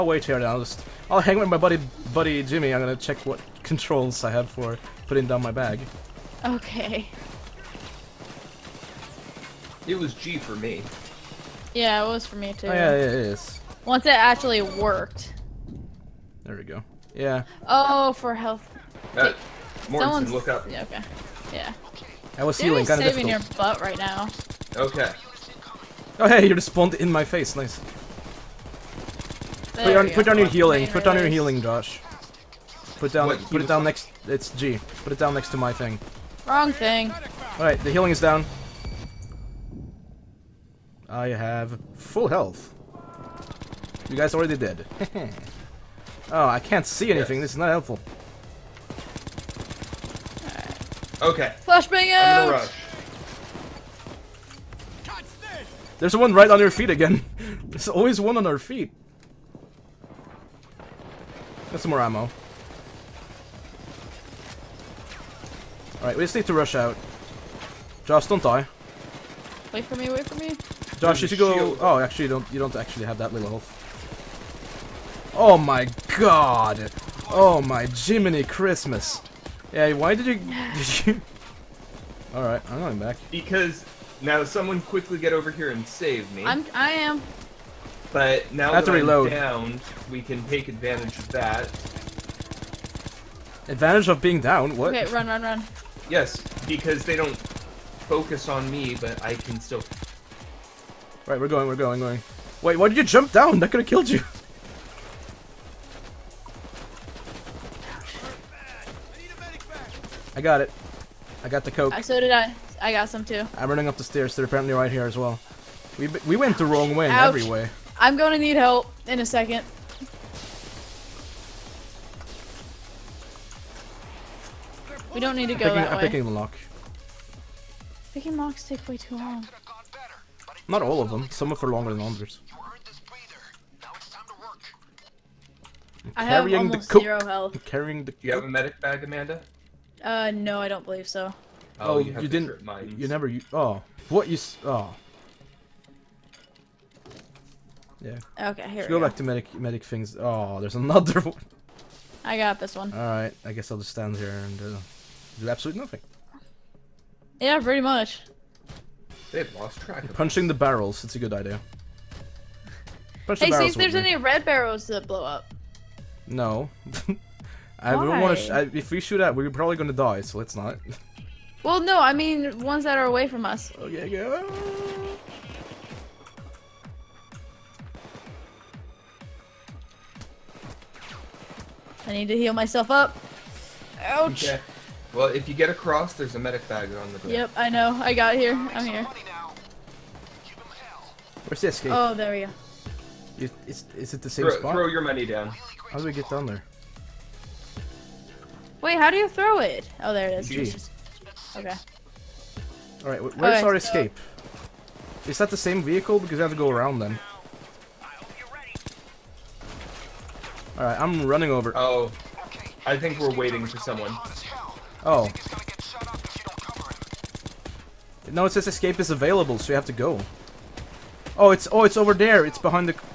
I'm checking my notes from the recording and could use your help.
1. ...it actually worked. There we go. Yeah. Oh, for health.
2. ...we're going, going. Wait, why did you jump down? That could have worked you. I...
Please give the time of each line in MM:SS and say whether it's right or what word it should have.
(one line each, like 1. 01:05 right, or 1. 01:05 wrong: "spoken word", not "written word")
1. 00:14 right
2. 01:41 wrong: "killed", not "worked".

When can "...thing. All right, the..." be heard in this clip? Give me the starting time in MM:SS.
00:36.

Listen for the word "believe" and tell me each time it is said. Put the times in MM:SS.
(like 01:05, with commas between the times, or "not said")
02:20.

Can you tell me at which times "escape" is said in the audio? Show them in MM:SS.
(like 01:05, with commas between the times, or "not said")
03:23, 03:38.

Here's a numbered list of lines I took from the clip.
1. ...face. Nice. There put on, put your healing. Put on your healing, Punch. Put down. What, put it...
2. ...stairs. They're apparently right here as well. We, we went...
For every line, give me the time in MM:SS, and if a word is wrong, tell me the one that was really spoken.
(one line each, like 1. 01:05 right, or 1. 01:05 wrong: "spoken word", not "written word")
1. 00:27 wrong: "Josh", not "Punch"
2. 01:54 right.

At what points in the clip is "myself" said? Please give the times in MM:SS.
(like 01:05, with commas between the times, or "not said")
03:02.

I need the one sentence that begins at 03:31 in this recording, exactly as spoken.
Oh, I think we're waiting for someone.